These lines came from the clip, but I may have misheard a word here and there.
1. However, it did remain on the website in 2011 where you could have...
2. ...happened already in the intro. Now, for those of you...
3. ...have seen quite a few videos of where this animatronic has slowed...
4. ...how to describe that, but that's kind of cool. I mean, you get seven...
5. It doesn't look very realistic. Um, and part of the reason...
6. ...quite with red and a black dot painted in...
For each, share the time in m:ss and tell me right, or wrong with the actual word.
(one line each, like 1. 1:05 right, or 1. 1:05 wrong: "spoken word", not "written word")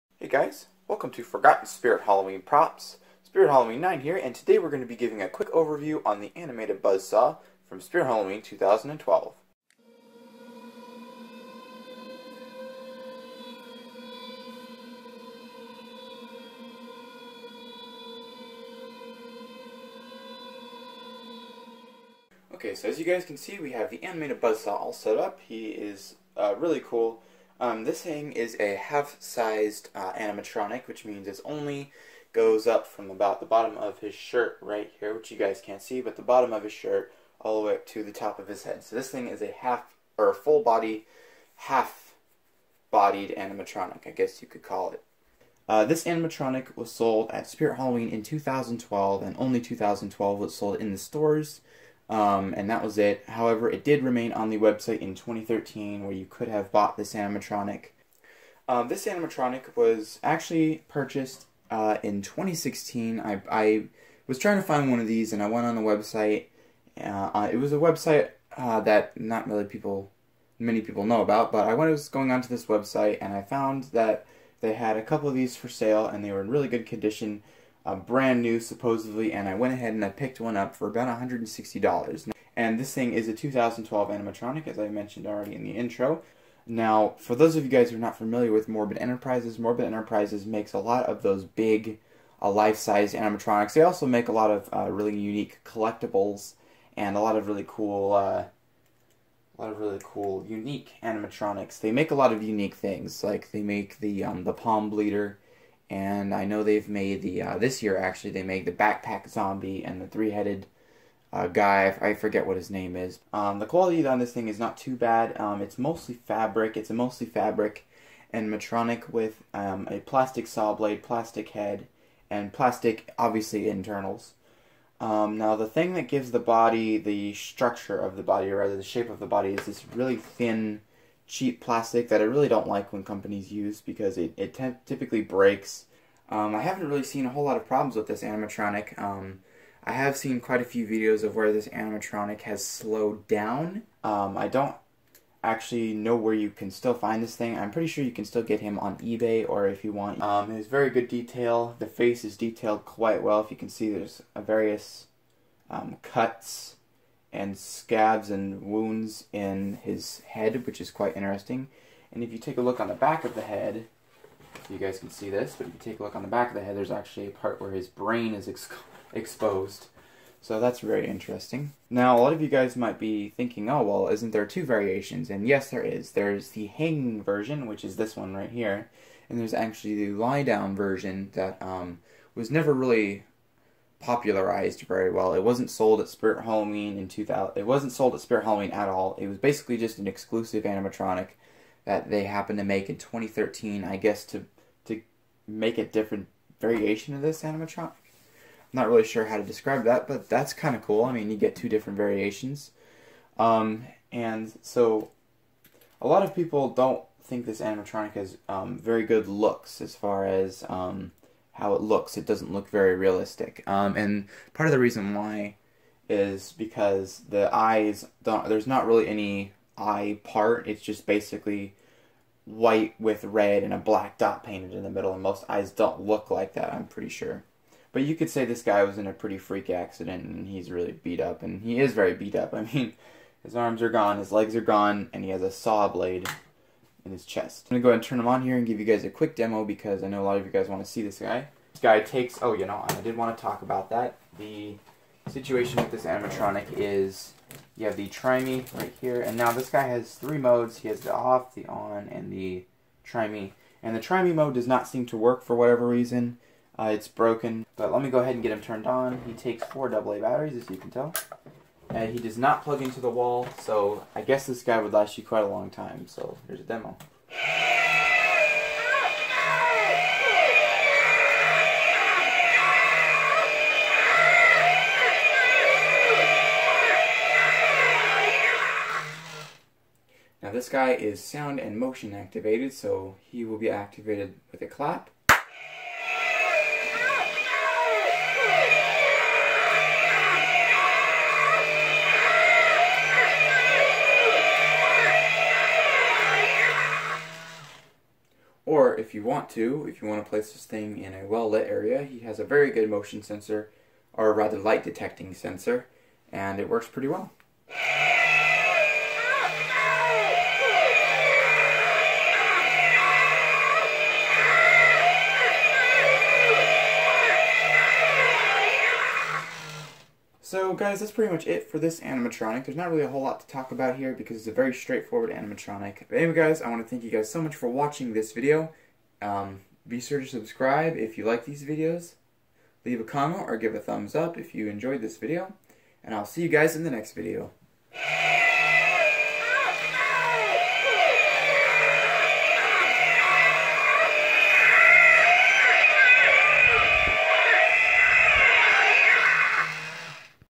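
1. 0:53 wrong: "2013", not "2011"
2. 1:24 wrong: "mentioned", not "happened"
3. 2:19 right
4. 3:19 wrong: "two", not "seven"
5. 3:32 right
6. 3:42 wrong: "white", not "quite".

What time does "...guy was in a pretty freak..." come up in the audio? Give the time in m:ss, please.
3:48.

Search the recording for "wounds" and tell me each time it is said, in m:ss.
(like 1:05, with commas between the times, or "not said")
2:38.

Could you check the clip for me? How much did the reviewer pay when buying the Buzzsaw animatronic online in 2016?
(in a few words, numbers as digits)
$160.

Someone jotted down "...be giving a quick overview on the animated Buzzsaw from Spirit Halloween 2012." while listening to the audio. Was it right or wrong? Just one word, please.
right.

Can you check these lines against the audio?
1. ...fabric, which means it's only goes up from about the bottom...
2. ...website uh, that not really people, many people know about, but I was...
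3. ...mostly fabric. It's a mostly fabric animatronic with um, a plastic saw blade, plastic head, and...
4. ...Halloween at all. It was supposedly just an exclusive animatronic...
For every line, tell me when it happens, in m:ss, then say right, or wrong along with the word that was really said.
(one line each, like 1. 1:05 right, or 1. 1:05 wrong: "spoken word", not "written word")
1. 0:30 wrong: "animatronic", not "fabric"
2. 1:07 right
3. 1:55 right
4. 3:08 wrong: "basically", not "supposedly".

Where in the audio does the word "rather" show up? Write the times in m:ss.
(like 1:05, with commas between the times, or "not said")
2:08, 5:04.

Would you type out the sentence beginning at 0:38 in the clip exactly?
So this thing is a half or full body, half bodied animatronic, I guess you could call it.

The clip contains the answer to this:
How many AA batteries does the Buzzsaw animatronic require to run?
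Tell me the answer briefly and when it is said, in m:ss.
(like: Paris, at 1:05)
4, at 4:19.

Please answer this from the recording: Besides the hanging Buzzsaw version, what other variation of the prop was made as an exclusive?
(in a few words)
lie down version.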